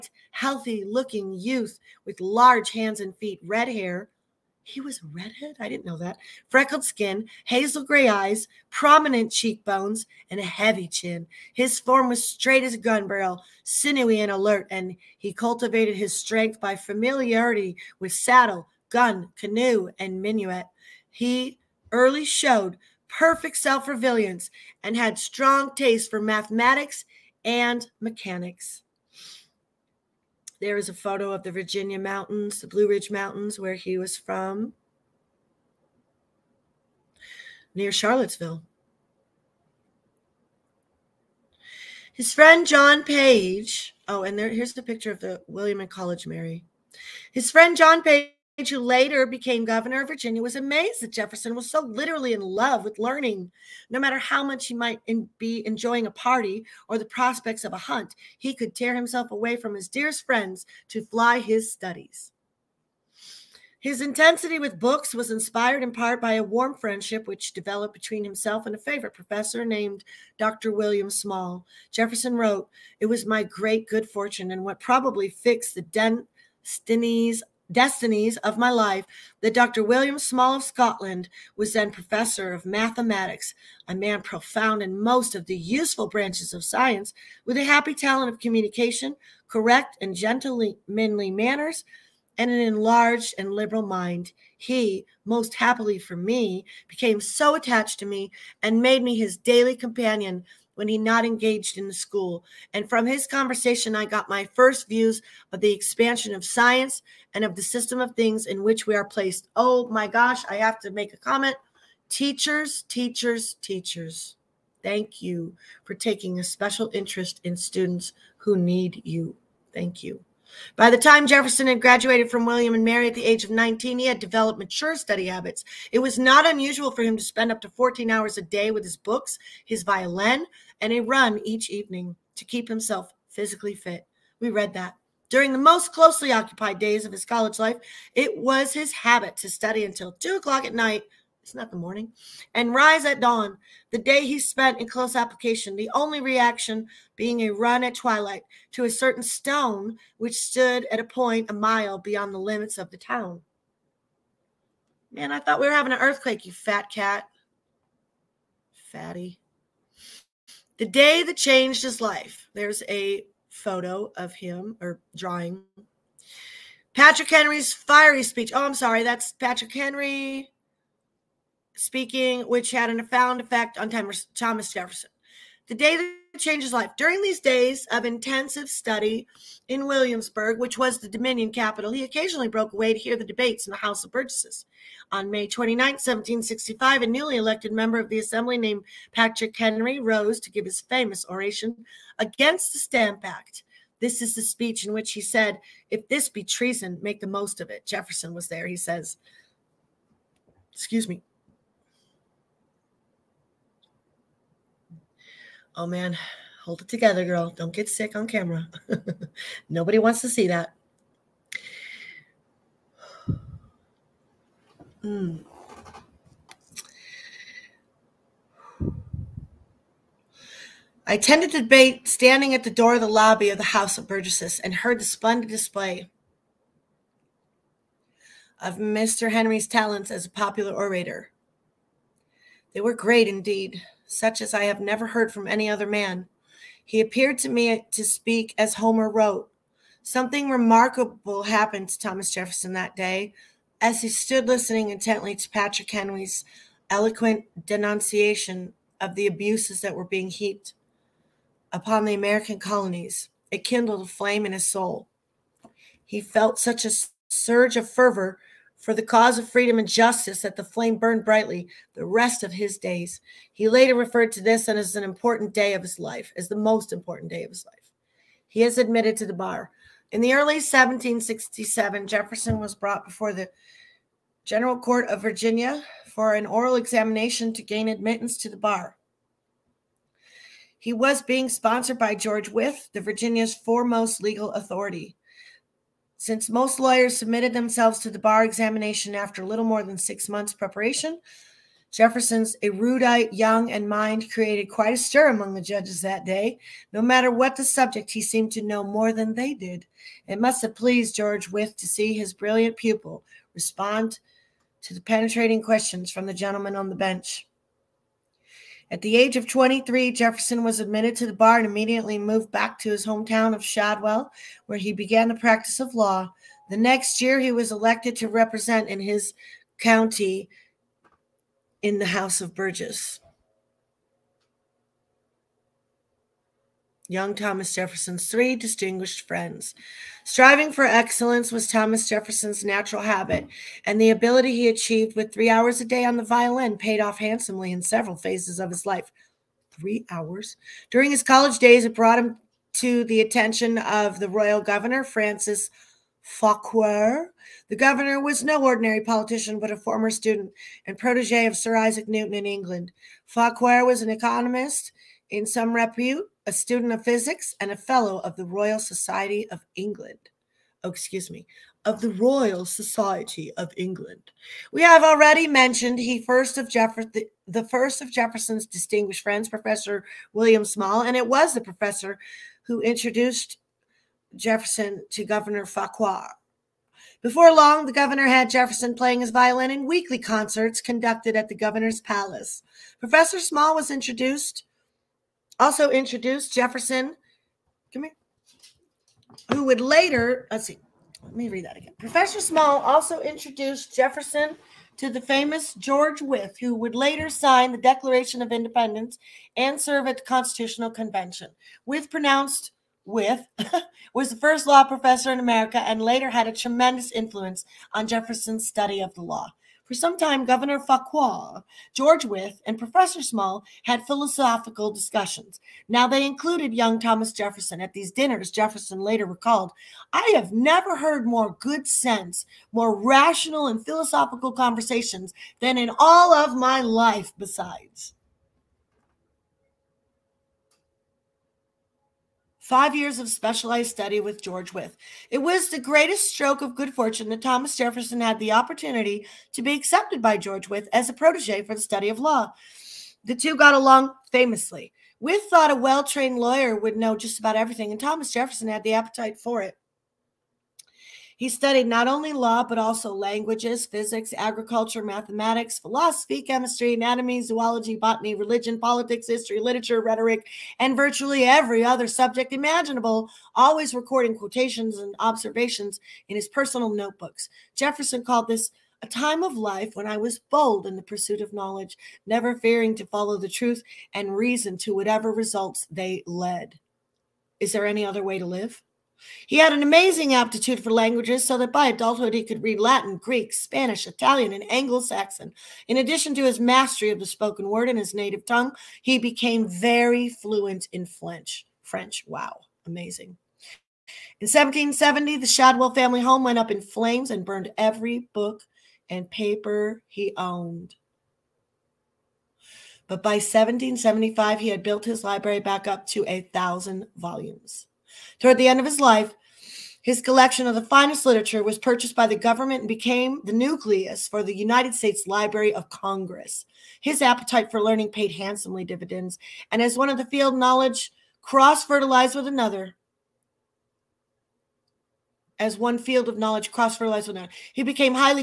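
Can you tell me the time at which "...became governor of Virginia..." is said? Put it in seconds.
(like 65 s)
49 s.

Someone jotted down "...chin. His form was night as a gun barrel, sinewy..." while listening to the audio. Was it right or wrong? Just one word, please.
wrong.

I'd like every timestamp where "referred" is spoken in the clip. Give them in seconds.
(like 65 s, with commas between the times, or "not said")
263 s.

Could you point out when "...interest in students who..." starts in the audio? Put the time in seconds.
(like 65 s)
116 s.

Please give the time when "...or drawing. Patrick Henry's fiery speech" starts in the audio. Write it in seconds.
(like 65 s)
164 s.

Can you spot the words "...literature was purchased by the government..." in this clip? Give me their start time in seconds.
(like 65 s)
511 s.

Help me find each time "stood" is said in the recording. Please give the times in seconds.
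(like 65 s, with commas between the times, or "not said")
150 s, 244 s.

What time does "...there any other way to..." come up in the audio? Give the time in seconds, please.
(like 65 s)
477 s.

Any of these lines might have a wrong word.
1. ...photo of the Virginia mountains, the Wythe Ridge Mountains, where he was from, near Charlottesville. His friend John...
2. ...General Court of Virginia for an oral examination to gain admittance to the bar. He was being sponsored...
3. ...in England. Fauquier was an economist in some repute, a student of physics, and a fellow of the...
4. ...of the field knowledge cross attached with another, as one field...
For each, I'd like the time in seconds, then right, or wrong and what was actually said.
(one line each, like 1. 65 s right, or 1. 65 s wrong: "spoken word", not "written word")
1. 30 s wrong: "Blue", not "Wythe"
2. 274 s right
3. 352 s right
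4. 520 s wrong: "fertilized", not "attached".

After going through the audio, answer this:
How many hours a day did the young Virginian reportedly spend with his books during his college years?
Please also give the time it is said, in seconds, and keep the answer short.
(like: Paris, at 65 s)
14, at 127 s.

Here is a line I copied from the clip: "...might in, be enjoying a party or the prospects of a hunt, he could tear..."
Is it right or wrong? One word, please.
right.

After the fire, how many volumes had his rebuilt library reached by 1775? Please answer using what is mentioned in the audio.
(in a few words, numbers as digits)
1000.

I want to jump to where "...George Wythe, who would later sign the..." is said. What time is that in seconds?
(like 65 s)
395 s.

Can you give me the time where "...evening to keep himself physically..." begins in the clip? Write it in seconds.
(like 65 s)
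131 s.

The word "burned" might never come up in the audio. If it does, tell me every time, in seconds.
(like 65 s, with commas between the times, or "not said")
260 s, 497 s.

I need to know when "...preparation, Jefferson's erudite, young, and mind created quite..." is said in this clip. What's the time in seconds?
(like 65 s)
290 s.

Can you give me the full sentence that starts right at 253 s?
It kindled a flame in his soul.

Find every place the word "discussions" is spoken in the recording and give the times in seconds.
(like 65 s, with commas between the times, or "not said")
414 s.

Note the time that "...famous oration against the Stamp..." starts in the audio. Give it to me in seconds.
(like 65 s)
190 s.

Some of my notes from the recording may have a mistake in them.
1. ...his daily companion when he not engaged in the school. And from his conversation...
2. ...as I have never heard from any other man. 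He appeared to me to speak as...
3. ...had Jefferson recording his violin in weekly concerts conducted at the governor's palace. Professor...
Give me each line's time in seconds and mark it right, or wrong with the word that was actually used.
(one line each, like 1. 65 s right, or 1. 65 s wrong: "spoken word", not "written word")
1. 99 s right
2. 234 s right
3. 378 s wrong: "playing", not "recording".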